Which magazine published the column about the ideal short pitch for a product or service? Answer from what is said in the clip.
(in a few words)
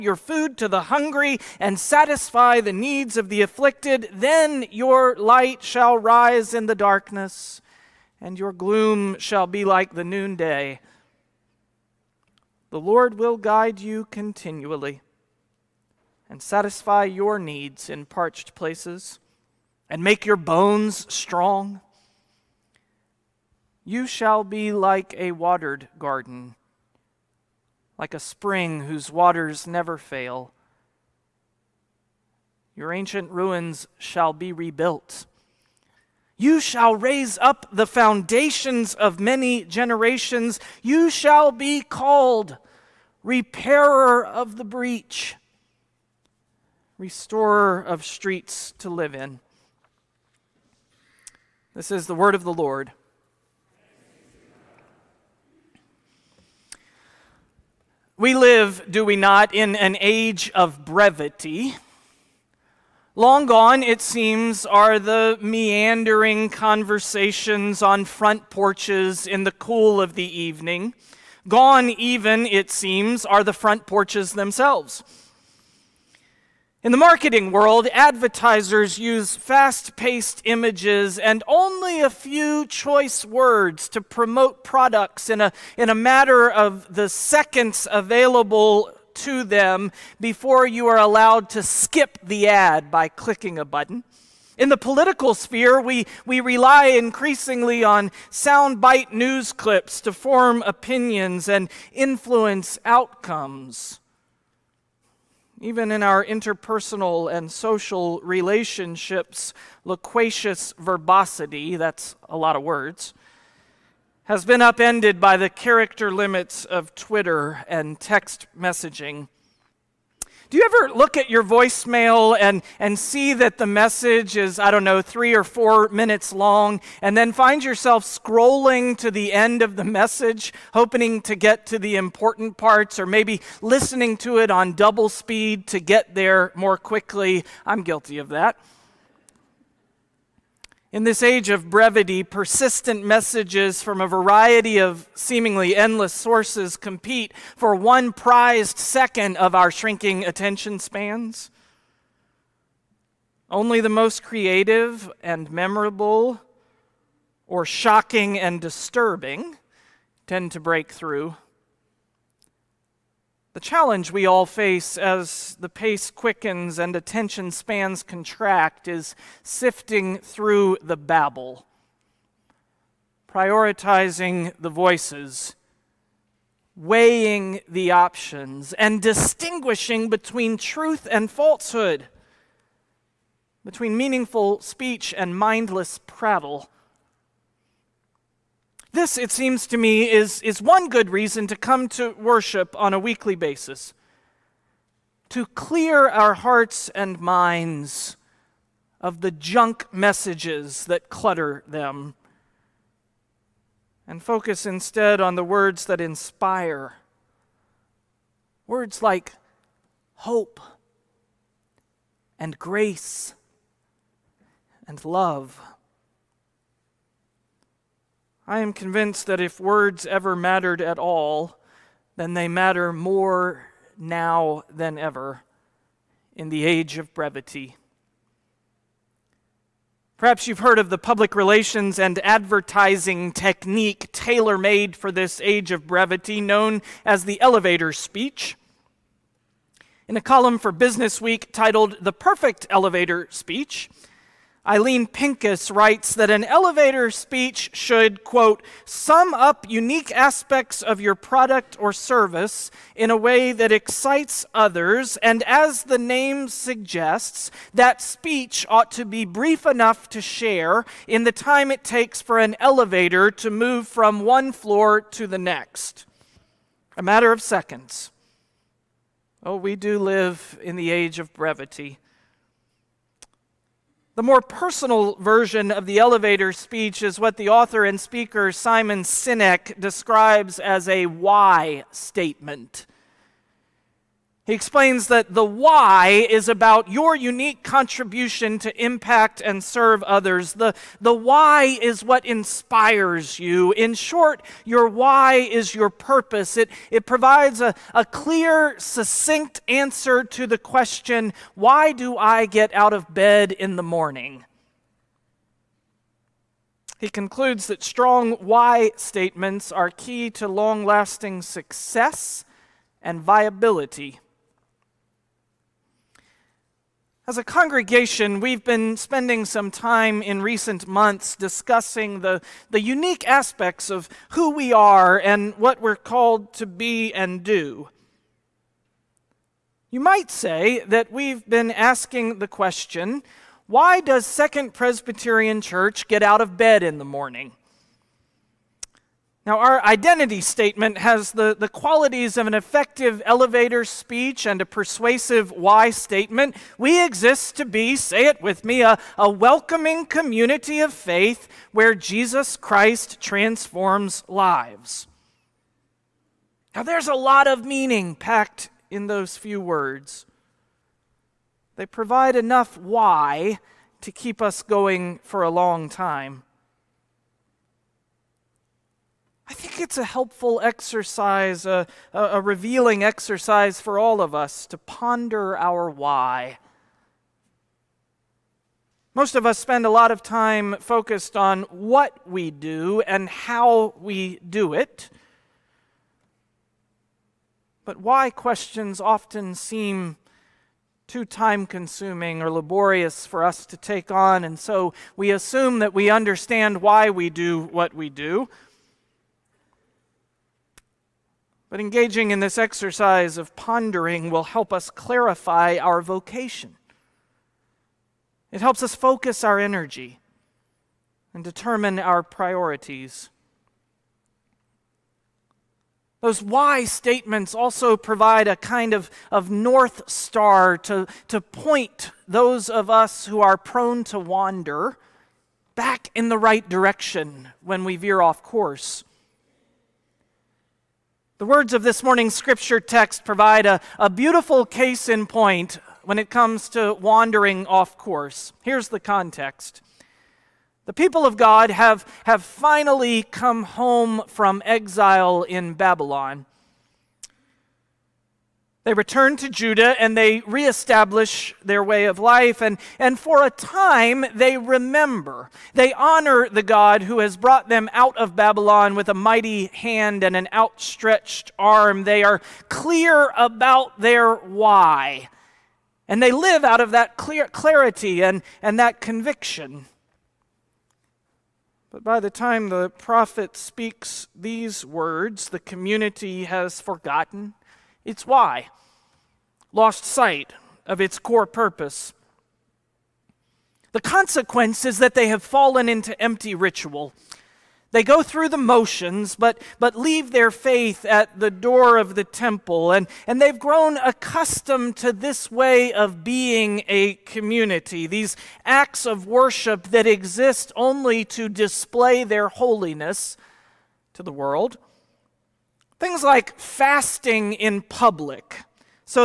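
Business Week.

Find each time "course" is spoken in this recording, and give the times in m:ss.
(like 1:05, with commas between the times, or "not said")
7:08, 7:17.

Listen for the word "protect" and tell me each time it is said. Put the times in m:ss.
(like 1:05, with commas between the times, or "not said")
not said.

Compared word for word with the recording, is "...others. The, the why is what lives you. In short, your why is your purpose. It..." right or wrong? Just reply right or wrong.
wrong.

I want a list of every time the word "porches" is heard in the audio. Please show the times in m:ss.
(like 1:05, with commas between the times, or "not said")
1:08, 1:13.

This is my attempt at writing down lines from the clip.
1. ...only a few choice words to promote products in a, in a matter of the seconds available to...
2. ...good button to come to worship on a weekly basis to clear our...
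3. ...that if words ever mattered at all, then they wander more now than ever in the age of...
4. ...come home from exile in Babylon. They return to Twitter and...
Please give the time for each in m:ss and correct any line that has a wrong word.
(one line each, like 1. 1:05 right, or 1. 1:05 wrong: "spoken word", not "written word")
1. 1:21 right
2. 3:10 wrong: "reason", not "button"
3. 3:39 wrong: "matter", not "wander"
4. 7:23 wrong: "Judah", not "Twitter".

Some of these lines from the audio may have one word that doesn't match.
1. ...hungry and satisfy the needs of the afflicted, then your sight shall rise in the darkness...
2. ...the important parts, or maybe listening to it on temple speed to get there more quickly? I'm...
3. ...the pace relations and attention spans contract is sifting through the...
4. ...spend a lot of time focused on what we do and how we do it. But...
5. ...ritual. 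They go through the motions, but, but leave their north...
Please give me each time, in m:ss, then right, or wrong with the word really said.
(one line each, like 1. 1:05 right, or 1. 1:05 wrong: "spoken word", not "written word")
1. 0:00 wrong: "light", not "sight"
2. 2:11 wrong: "double", not "temple"
3. 2:45 wrong: "quickens", not "relations"
4. 6:19 right
5. 8:06 wrong: "faith", not "north".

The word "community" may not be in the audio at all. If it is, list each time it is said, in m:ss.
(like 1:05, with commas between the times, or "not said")
5:50, 7:55, 8:17.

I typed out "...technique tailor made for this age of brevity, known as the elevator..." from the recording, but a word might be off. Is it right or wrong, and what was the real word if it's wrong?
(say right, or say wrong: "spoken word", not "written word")
right.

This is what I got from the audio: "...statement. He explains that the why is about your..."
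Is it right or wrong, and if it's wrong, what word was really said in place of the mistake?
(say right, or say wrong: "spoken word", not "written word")
right.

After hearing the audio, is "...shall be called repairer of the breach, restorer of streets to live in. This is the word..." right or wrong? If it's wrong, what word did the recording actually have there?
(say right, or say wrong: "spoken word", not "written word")
right.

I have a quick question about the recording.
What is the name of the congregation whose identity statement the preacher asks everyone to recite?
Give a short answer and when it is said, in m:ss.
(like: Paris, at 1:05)
Second Presbyterian Church, at 5:34.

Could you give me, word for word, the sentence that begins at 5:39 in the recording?
Now, our identity statement has the, the qualities of an effective elevator speech and a persuasive why statement.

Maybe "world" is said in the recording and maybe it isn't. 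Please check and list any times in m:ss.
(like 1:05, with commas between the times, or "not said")
1:17, 8:24.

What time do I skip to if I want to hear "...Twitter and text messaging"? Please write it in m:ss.
1:56.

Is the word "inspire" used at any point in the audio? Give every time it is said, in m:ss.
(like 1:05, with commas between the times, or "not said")
3:26, 4:52.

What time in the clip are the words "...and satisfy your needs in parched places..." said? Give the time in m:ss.
0:16.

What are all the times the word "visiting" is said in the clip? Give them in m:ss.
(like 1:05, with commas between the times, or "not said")
not said.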